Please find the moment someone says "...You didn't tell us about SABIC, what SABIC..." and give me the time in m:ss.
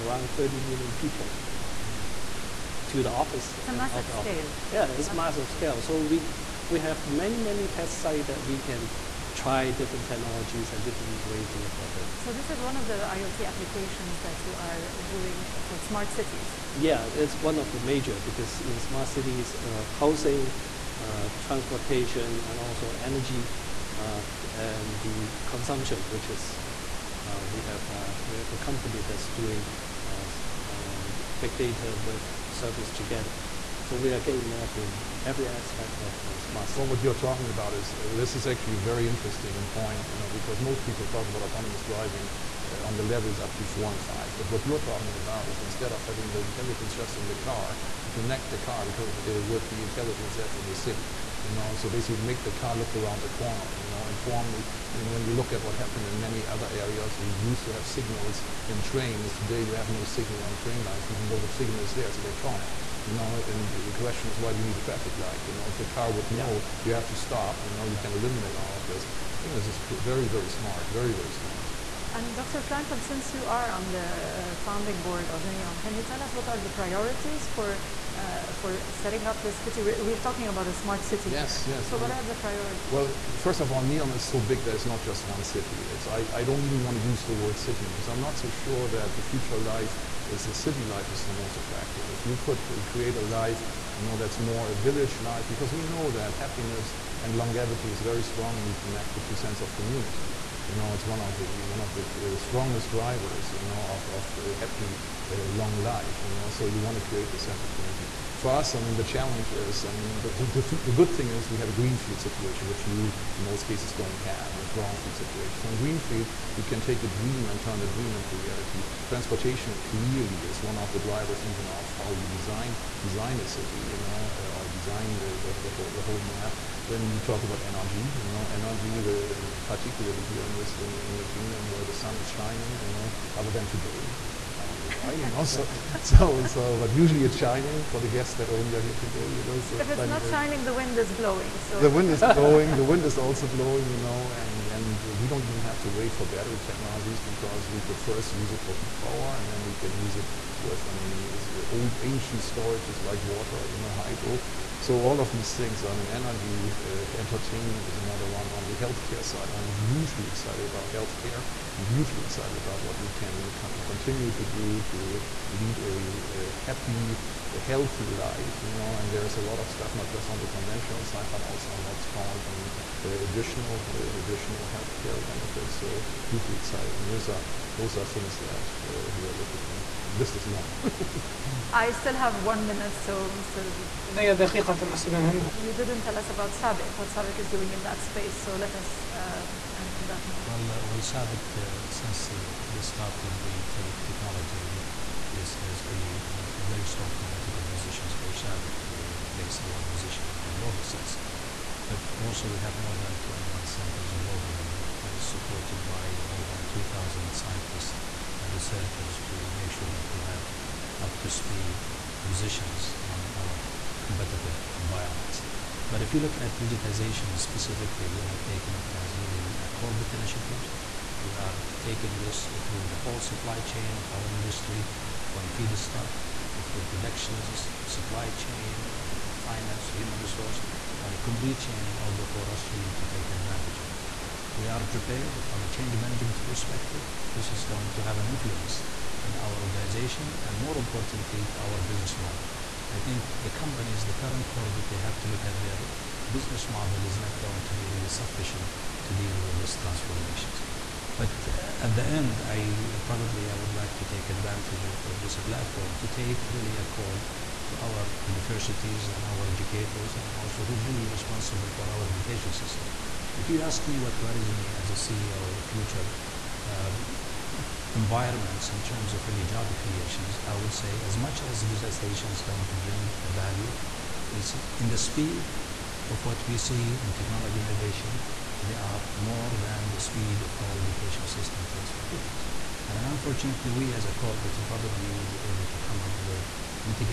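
3:04.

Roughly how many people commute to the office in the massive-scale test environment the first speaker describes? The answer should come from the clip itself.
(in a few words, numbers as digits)
30 million.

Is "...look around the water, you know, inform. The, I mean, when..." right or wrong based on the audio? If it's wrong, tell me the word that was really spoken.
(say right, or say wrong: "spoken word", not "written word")
wrong: "corner", not "water".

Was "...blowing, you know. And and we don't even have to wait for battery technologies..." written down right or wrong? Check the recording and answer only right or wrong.
right.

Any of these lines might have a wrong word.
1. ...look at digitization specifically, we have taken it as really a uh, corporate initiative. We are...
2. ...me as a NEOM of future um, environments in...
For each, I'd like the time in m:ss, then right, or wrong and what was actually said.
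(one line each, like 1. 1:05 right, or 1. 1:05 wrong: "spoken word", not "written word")
1. 3:36 right
2. 4:24 wrong: "CEO", not "NEOM".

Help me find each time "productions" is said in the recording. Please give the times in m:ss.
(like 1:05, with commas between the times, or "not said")
3:46.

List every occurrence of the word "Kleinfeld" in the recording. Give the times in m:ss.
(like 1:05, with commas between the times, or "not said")
1:12.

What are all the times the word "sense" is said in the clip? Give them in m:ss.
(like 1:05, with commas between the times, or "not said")
1:39, 1:47, 3:20.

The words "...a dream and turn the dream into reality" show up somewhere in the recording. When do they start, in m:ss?
1:57.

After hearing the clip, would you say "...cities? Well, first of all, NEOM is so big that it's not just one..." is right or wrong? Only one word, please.
wrong.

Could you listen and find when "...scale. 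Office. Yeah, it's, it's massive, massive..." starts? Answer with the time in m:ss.
0:04.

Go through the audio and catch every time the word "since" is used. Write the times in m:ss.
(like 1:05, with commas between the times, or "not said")
1:13, 3:11.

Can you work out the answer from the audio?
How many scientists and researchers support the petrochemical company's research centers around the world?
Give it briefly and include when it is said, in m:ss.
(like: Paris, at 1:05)
2,000, at 3:26.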